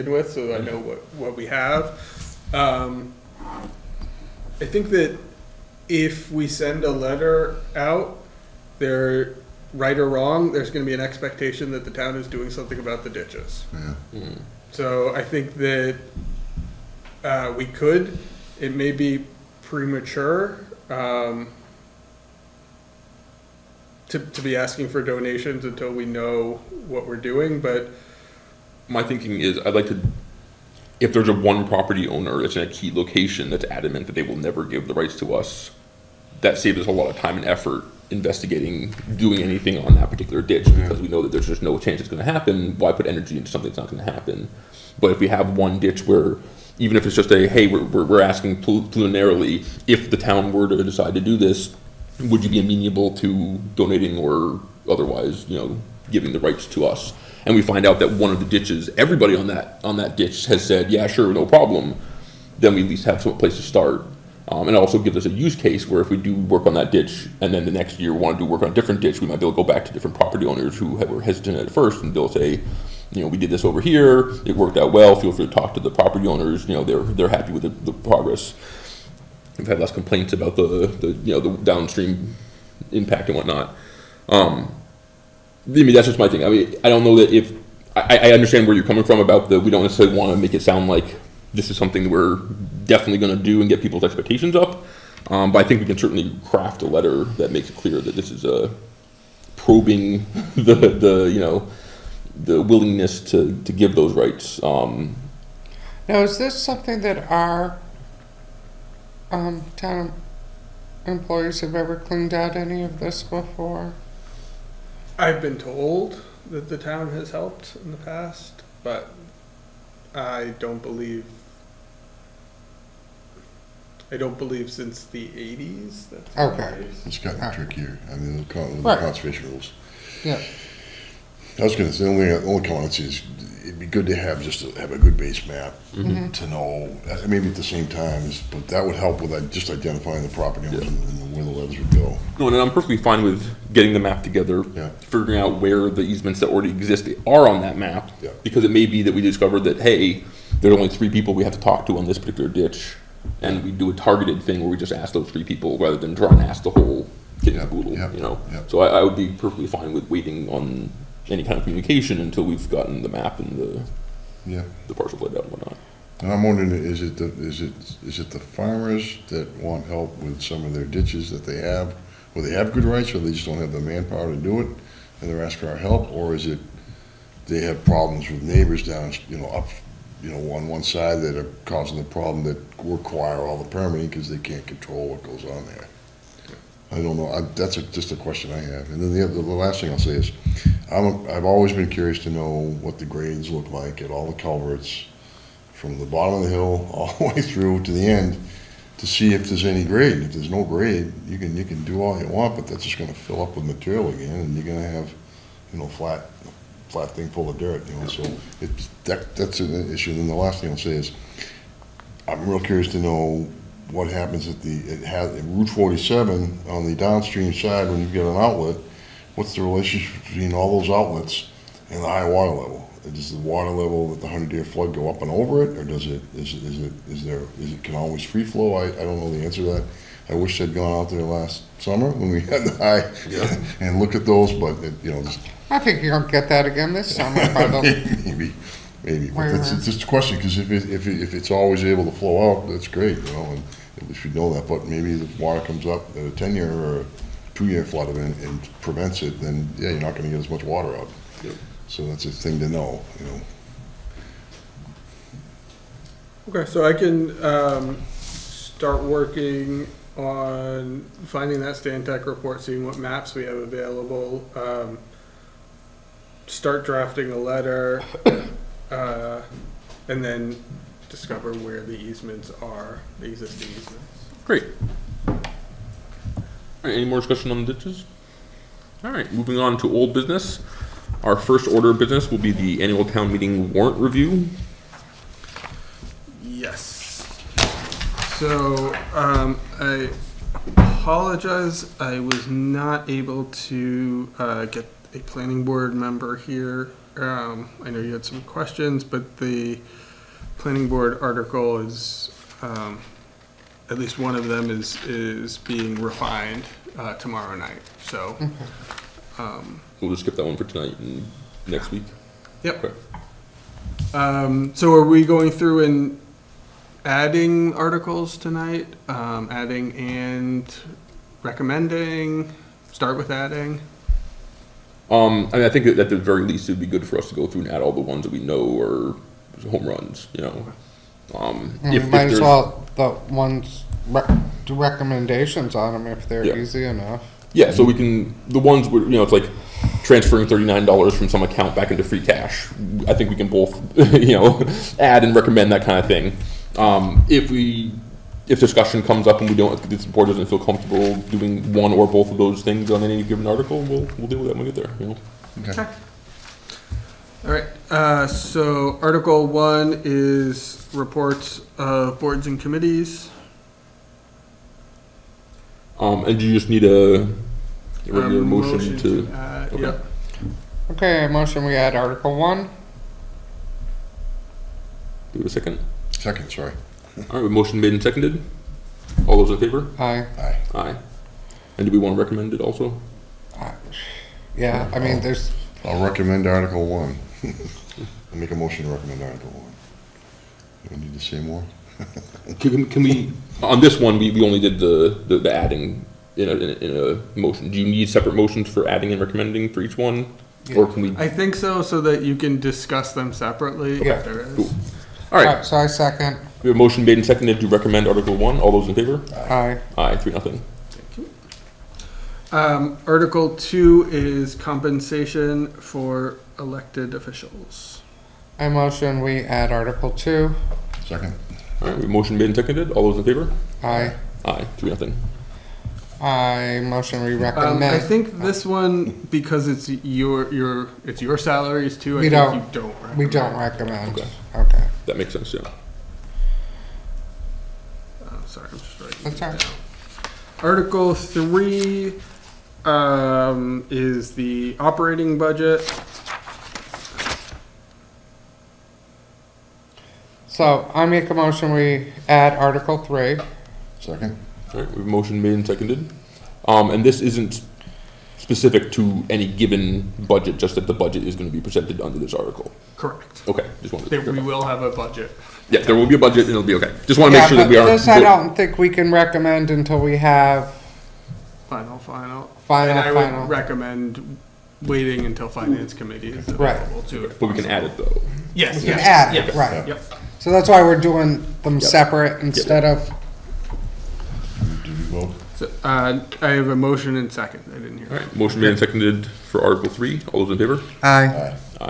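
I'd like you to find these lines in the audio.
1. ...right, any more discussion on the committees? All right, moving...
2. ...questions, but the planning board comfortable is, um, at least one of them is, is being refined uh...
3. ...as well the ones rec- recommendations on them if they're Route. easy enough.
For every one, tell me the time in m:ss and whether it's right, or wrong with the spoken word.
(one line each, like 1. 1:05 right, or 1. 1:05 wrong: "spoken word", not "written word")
1. 4:36 wrong: "ditches", not "committees"
2. 4:58 wrong: "article", not "comfortable"
3. 5:32 wrong: "Yeah", not "Route".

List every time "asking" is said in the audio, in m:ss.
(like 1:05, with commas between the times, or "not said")
0:24, 0:48, 2:55.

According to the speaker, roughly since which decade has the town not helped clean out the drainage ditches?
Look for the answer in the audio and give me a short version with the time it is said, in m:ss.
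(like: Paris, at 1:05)
the 80s, at 2:05.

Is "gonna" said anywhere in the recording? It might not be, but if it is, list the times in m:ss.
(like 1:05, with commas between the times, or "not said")
2:11, 3:56, 7:41.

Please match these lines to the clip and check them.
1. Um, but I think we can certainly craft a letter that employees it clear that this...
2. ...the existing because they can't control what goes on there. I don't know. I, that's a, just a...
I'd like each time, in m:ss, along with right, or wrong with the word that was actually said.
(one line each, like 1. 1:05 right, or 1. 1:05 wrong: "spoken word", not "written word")
1. 1:35 wrong: "makes", not "employees"
2. 3:03 wrong: "permitting", not "existing".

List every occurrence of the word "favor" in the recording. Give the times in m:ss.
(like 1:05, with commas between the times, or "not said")
6:19, 6:48, 7:03, 8:10.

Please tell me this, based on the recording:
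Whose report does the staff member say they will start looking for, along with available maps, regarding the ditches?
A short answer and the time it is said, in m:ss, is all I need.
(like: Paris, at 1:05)
Stantec, at 4:21.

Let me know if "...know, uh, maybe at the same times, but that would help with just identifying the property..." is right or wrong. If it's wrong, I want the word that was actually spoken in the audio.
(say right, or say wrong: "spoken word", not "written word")
right.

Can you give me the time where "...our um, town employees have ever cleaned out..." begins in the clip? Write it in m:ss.
1:47.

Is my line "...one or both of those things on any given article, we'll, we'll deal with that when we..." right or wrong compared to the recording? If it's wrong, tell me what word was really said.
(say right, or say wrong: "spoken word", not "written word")
right.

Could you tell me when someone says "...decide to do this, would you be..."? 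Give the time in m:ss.
0:50.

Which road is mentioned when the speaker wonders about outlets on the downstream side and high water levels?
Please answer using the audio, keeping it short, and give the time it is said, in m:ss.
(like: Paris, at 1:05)
Route 47, at 3:35.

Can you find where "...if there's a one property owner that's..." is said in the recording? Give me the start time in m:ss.
0:30.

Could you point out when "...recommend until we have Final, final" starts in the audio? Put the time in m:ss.
7:49.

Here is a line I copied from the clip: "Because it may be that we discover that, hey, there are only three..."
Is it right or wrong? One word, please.
right.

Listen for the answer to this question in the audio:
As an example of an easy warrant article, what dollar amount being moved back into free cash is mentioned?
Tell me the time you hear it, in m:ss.
5:40.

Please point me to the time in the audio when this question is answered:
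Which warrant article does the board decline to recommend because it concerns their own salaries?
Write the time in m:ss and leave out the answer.
6:54.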